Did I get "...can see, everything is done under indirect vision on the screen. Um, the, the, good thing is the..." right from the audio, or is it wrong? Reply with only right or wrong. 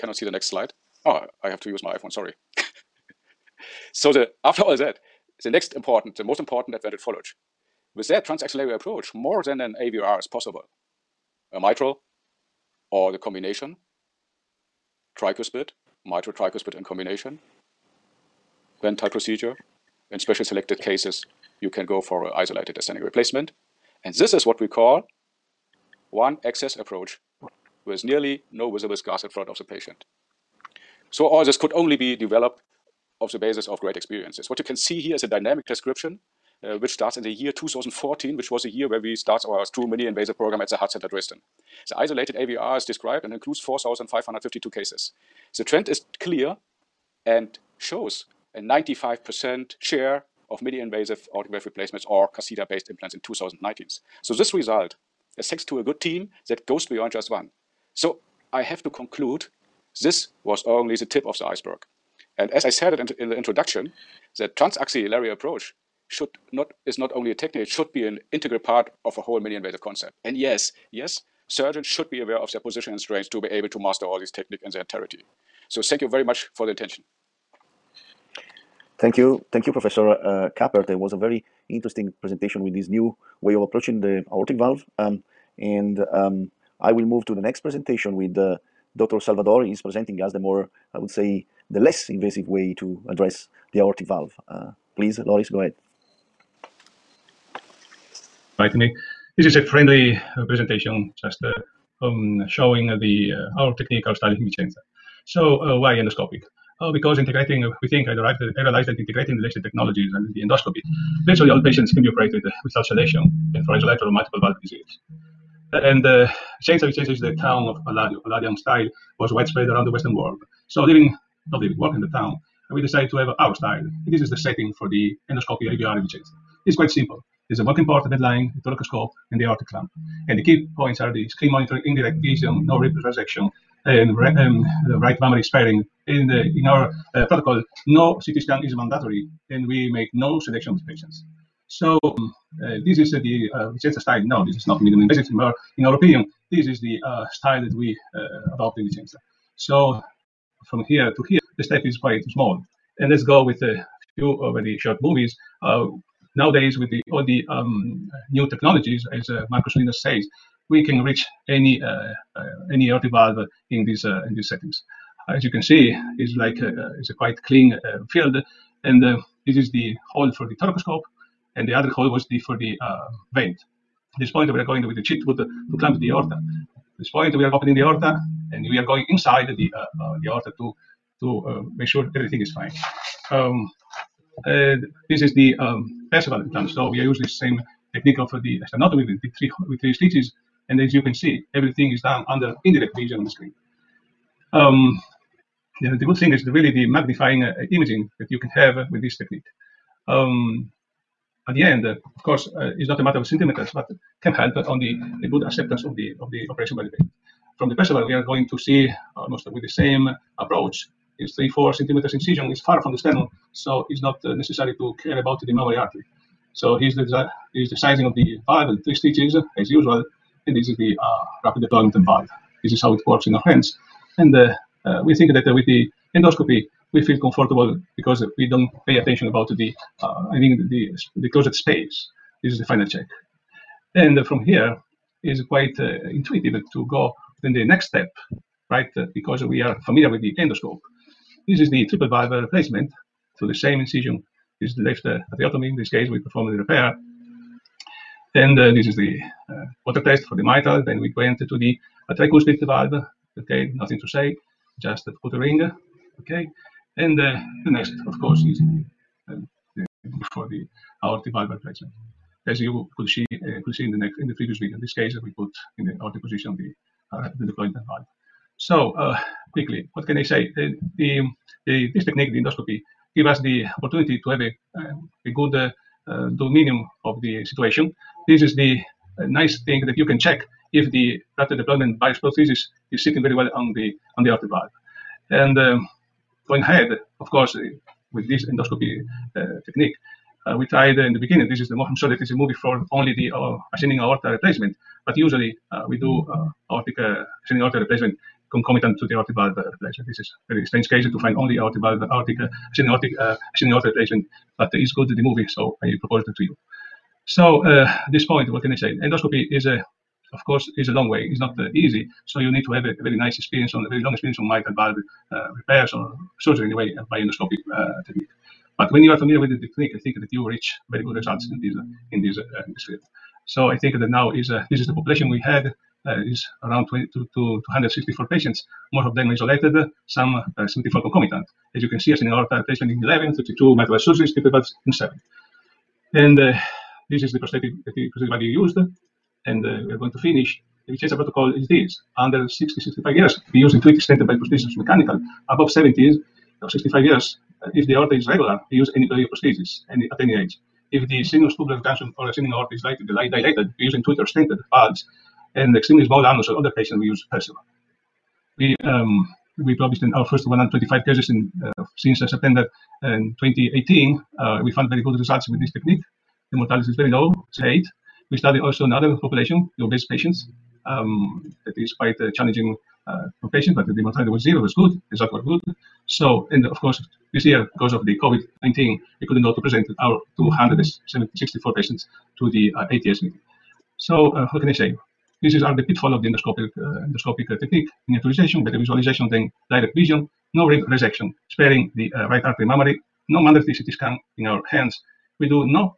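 right.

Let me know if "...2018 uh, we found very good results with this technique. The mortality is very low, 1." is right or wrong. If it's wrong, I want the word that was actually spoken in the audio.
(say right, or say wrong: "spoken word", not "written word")
wrong: "8", not "1".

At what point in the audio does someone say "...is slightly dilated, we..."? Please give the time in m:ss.
5:52.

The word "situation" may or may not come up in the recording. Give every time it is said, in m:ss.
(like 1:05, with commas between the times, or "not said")
4:37.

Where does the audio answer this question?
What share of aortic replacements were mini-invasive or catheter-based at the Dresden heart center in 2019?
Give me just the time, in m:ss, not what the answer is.
0:48.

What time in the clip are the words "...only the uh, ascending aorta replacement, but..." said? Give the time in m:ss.
4:52.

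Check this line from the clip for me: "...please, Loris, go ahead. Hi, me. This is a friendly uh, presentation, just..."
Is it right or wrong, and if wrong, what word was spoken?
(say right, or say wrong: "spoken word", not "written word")
right.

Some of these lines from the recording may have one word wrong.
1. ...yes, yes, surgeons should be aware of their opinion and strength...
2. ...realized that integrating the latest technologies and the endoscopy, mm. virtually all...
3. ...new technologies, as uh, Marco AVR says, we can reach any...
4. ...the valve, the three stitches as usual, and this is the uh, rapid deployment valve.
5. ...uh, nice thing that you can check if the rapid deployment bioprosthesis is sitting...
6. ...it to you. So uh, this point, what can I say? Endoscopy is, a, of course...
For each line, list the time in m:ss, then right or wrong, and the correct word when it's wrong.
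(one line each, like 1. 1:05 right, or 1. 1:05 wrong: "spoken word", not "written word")
1. 1:10 wrong: "position", not "opinion"
2. 1:48 right
3. 2:38 wrong: "Solinas", not "AVR"
4. 3:38 right
5. 4:39 right
6. 5:06 right.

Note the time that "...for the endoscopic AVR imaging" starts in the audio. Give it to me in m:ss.
2:04.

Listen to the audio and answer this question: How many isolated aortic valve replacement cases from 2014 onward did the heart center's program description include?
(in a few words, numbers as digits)
4,552.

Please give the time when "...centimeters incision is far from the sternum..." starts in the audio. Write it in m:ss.
3:31.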